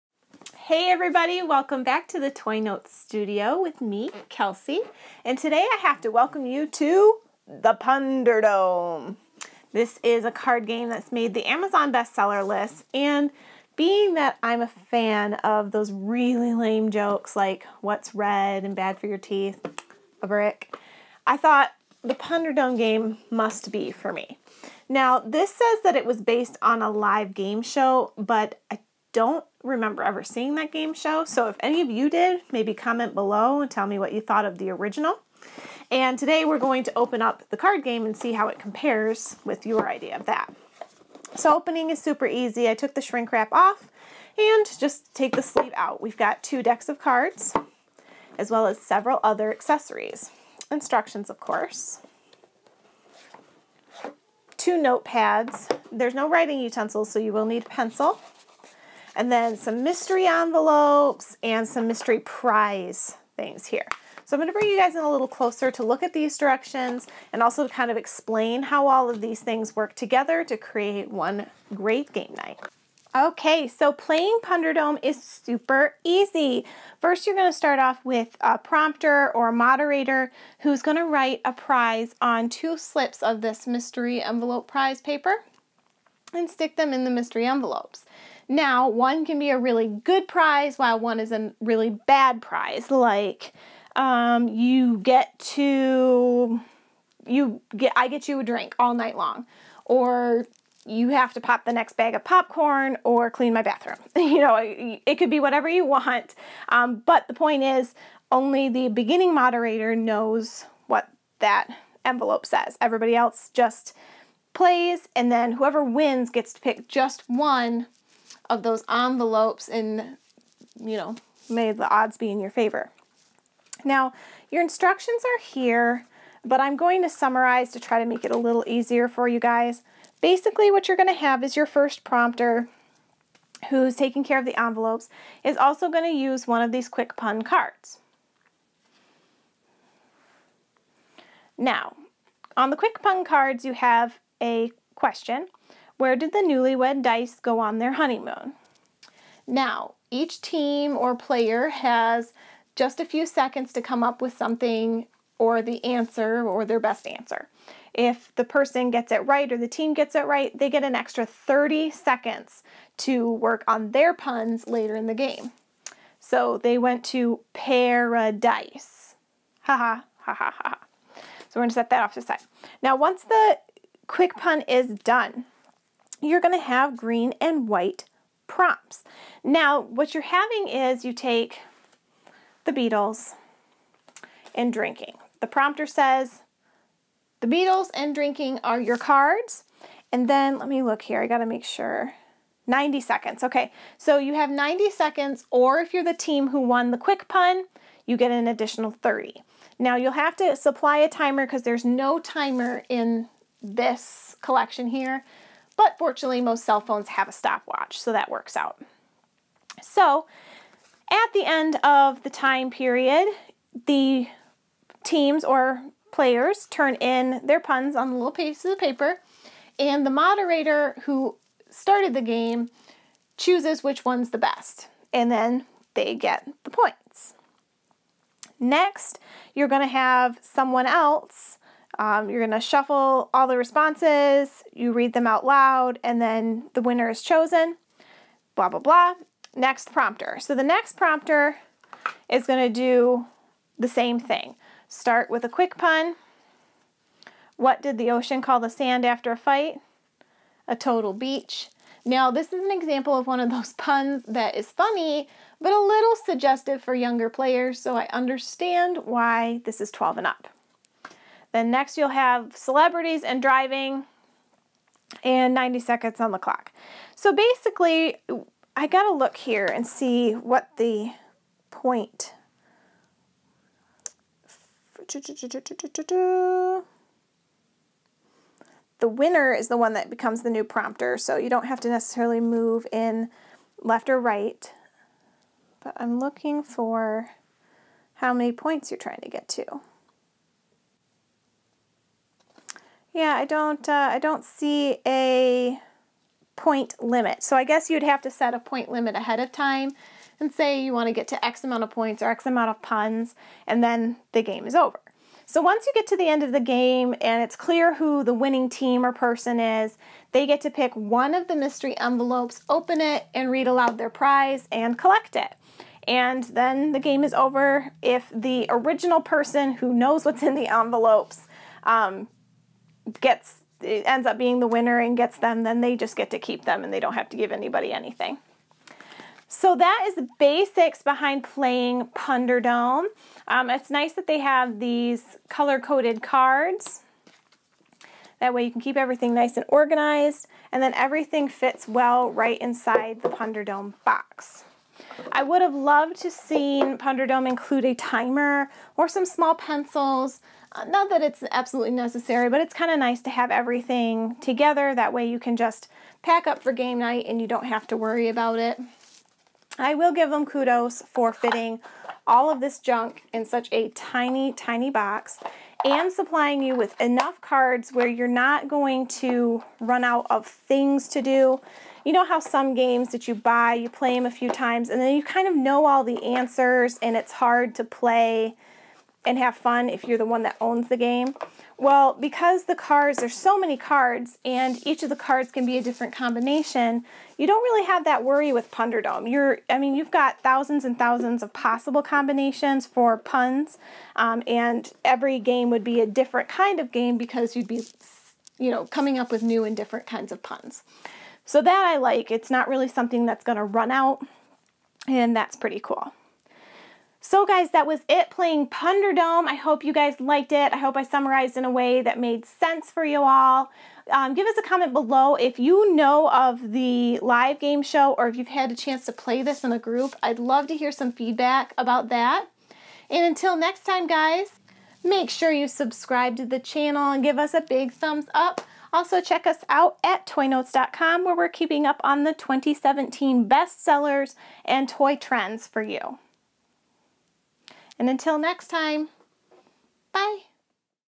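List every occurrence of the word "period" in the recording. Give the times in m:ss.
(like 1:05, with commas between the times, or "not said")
3:32.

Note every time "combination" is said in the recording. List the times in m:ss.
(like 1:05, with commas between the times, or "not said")
6:26, 6:32.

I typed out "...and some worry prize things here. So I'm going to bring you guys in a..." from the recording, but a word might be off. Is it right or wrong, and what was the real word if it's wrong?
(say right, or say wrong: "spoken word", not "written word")
wrong: "mystery", not "worry".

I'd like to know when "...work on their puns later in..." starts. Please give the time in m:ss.
2:43.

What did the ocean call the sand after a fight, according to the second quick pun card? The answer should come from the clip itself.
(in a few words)
A total beach.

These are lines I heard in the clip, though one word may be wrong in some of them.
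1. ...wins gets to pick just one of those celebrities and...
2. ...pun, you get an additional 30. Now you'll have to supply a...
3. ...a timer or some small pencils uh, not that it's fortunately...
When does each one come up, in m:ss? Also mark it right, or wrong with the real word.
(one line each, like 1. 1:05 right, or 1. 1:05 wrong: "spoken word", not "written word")
1. 1:55 wrong: "envelopes", not "celebrities"
2. 3:17 right
3. 5:47 wrong: "absolutely", not "fortunately".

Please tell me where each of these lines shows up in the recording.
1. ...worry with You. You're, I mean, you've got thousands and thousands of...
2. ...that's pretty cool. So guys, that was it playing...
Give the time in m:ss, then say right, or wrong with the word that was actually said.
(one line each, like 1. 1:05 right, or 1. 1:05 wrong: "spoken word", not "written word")
1. 6:28 wrong: "Punderdome", not "You"
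2. 6:45 right.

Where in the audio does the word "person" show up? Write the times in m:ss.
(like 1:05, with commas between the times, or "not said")
2:38, 5:09, 5:19.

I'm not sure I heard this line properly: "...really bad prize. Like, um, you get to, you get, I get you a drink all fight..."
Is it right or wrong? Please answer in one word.
wrong.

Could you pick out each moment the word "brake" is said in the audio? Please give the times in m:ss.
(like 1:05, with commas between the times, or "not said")
not said.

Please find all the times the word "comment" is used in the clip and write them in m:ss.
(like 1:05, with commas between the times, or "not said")
0:32, 6:54.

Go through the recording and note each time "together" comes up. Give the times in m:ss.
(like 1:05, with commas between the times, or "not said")
1:09, 5:54.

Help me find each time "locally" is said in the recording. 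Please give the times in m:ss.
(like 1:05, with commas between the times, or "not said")
not said.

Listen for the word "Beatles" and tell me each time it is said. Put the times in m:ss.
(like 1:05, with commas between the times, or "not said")
3:02, 3:07.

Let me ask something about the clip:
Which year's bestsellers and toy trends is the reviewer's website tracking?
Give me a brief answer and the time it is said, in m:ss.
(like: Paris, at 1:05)
2017, at 7:12.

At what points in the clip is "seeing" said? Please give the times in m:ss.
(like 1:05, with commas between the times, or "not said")
0:30.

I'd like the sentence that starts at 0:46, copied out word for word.
We've got two decks of cards as well as several other accessories.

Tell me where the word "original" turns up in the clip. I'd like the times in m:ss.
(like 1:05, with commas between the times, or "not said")
0:34, 5:18.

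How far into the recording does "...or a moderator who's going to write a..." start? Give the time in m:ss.
1:19.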